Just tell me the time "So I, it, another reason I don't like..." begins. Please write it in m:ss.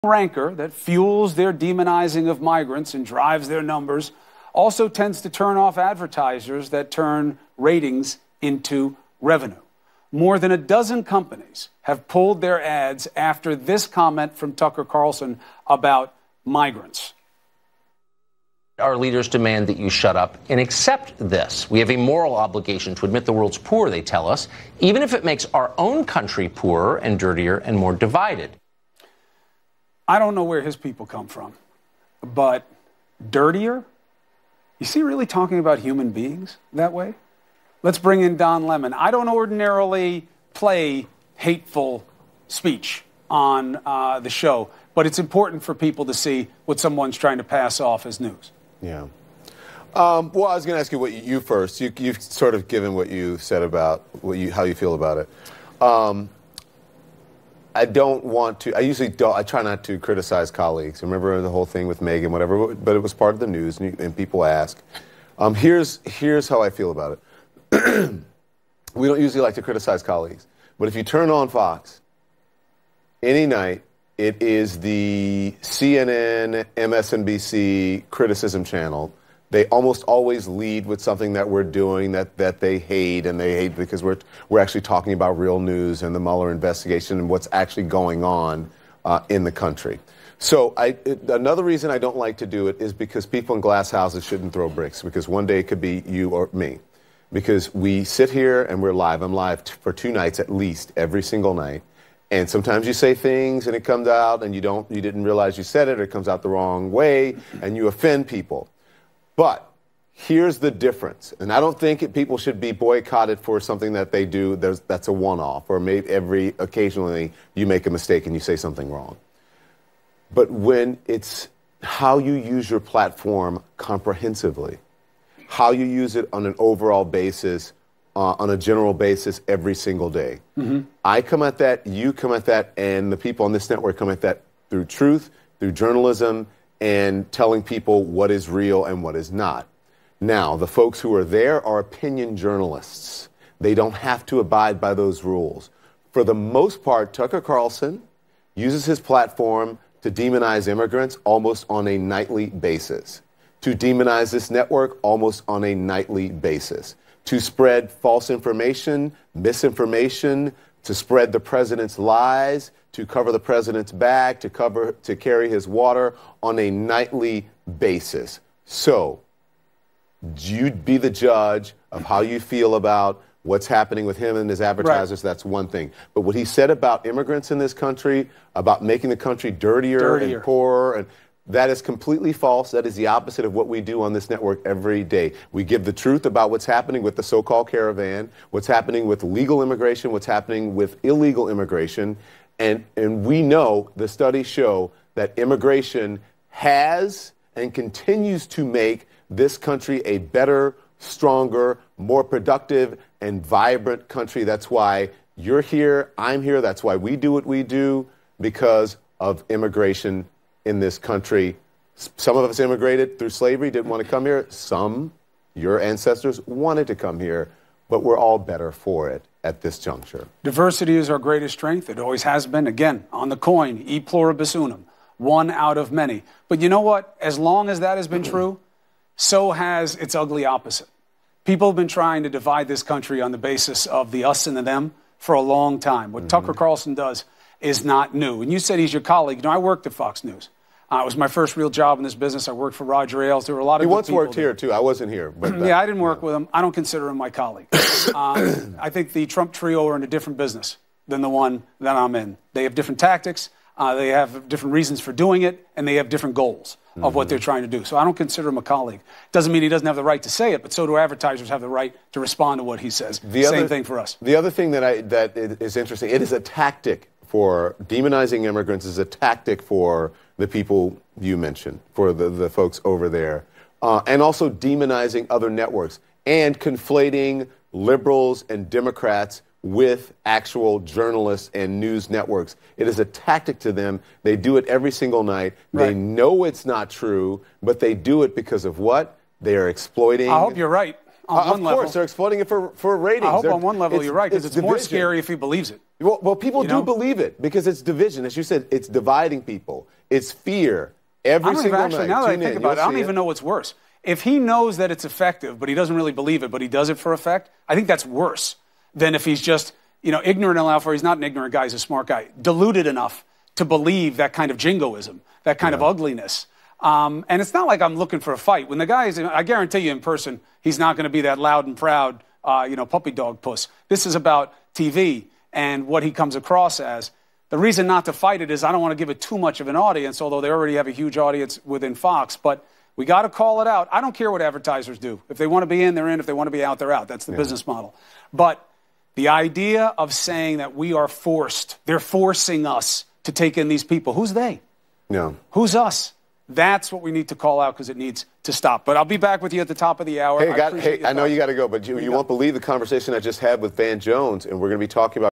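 1:30.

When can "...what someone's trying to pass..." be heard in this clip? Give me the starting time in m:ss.
0:46.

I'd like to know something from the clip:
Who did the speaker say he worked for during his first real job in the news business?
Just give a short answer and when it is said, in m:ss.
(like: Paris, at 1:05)
Roger Ailes, at 4:02.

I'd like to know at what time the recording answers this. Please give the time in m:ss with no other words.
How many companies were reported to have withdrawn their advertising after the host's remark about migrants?
0:10.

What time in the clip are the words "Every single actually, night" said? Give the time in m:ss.
5:01.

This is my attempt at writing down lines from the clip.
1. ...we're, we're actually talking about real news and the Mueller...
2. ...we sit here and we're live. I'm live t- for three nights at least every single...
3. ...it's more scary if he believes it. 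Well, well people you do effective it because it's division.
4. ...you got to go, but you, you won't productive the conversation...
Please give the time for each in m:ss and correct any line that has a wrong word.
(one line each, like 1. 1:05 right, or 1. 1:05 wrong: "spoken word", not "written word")
1. 1:24 right
2. 1:37 wrong: "two", not "three"
3. 4:54 wrong: "believe", not "effective"
4. 5:51 wrong: "believe", not "productive".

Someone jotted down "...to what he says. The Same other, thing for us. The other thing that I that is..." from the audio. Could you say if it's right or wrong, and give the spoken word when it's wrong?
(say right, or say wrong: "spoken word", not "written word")
right.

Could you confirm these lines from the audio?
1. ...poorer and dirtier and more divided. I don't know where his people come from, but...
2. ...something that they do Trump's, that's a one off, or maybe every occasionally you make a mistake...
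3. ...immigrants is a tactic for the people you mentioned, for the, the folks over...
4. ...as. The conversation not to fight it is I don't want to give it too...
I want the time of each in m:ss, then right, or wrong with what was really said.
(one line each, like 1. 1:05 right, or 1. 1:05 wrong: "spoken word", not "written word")
1. 0:26 right
2. 1:53 wrong: "There", not "Trump"
3. 4:28 right
4. 5:26 wrong: "reason", not "conversation".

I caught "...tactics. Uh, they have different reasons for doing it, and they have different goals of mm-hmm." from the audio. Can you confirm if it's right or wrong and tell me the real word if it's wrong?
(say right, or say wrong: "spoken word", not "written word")
right.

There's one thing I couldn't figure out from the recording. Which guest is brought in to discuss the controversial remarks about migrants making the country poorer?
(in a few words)
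Don Lemon.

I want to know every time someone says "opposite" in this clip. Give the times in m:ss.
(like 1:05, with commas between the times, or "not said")
3:03, 3:50.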